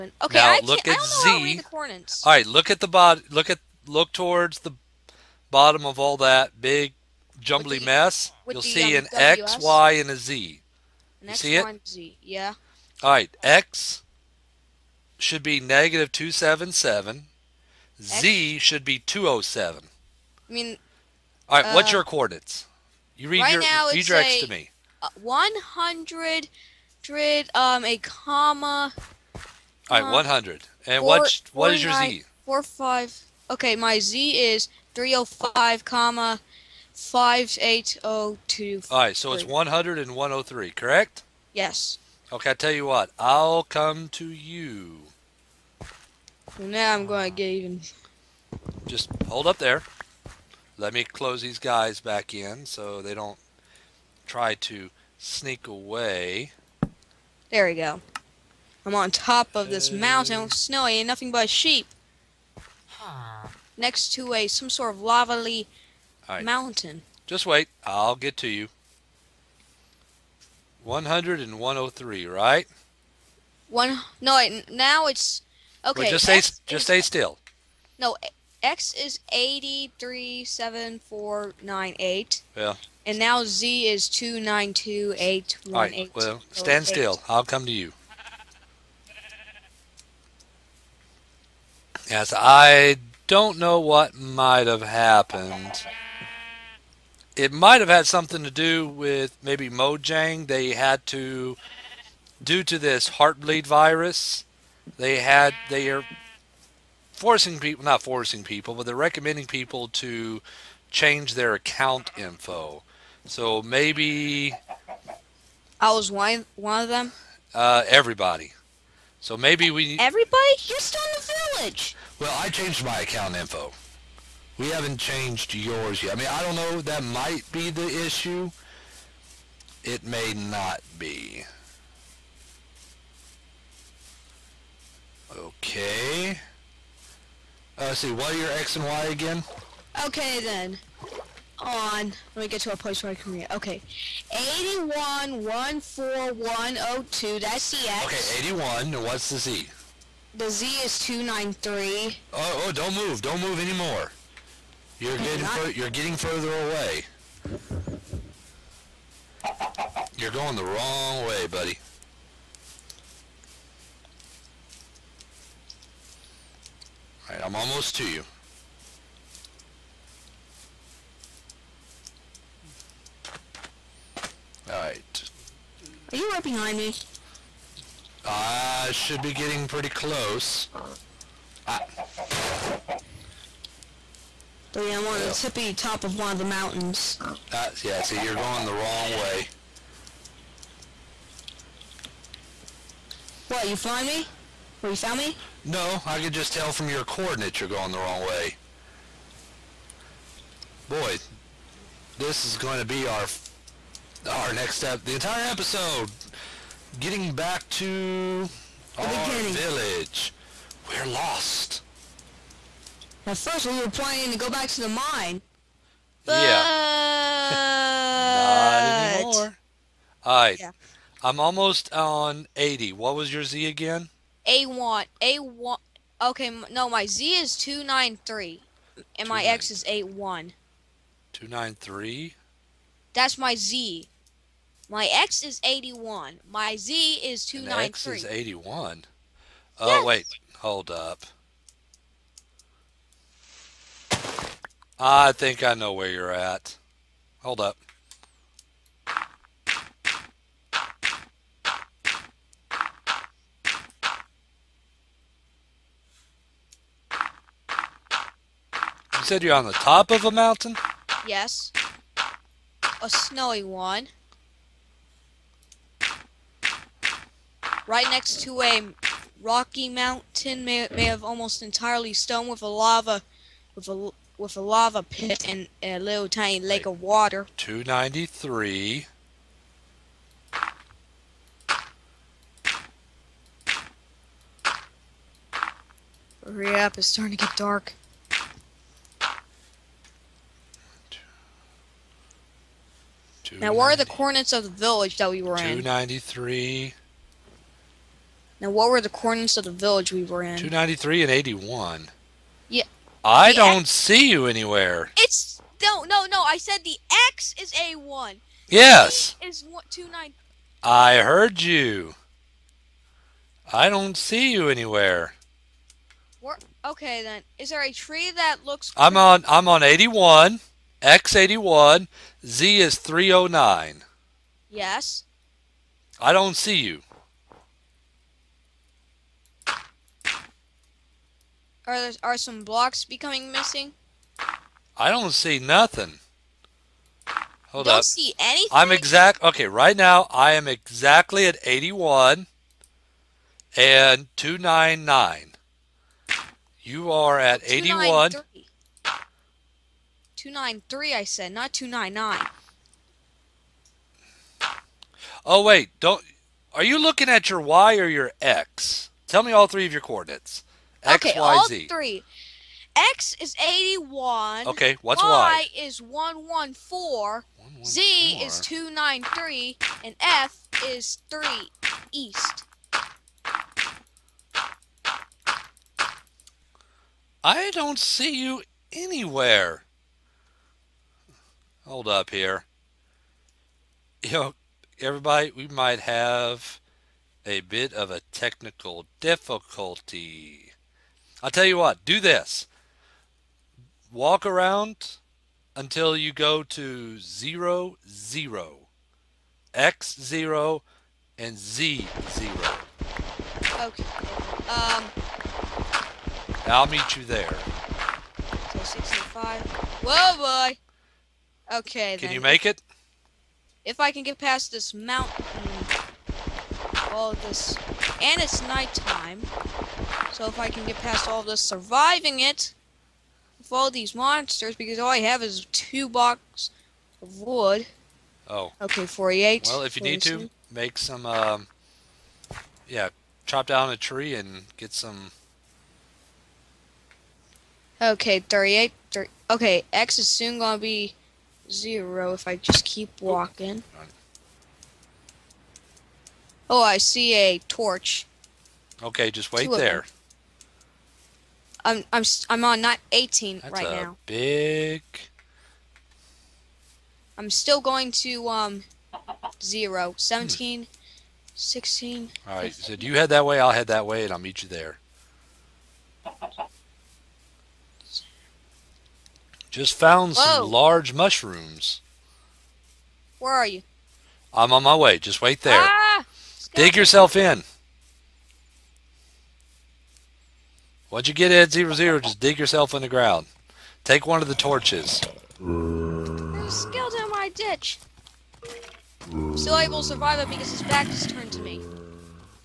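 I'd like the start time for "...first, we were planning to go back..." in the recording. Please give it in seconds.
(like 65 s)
213 s.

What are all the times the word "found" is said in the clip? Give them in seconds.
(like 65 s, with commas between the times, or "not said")
194 s, 469 s.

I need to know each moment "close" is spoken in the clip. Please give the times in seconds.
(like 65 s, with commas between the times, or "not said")
51 s, 179 s.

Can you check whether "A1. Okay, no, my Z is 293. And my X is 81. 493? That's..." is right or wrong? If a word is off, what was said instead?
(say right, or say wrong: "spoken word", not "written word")
wrong: "293", not "493".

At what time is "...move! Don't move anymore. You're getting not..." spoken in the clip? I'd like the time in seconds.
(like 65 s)
152 s.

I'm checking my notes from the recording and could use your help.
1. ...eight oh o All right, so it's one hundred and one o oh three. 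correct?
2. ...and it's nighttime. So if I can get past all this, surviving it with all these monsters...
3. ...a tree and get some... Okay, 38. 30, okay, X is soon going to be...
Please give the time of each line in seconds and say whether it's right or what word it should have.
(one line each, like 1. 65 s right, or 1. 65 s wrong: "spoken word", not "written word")
1. 37 s right
2. 418 s right
3. 433 s right.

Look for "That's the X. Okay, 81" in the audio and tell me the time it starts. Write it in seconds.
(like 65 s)
147 s.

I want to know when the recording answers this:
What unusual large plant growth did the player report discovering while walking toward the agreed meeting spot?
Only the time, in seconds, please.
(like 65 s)
470 s.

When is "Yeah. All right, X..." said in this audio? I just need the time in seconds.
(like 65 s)
12 s.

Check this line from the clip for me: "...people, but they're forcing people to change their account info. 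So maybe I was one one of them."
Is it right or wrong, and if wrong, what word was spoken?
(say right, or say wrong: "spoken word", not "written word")
wrong: "recommending", not "forcing".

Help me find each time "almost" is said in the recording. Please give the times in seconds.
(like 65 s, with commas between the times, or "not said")
167 s, 221 s, 271 s.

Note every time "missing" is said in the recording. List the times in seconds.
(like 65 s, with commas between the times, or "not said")
333 s.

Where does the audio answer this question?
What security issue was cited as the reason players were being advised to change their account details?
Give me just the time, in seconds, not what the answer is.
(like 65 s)
103 s.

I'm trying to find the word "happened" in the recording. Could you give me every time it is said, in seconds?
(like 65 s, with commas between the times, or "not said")
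94 s.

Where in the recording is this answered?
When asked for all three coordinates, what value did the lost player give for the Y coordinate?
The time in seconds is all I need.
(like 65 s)
365 s.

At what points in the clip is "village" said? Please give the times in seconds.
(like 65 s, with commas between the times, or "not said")
121 s, 209 s, 294 s, 299 s.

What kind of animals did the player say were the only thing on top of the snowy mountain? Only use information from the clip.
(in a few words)
sheep.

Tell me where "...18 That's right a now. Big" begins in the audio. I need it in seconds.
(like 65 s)
453 s.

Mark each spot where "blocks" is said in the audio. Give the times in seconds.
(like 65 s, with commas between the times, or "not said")
332 s, 426 s.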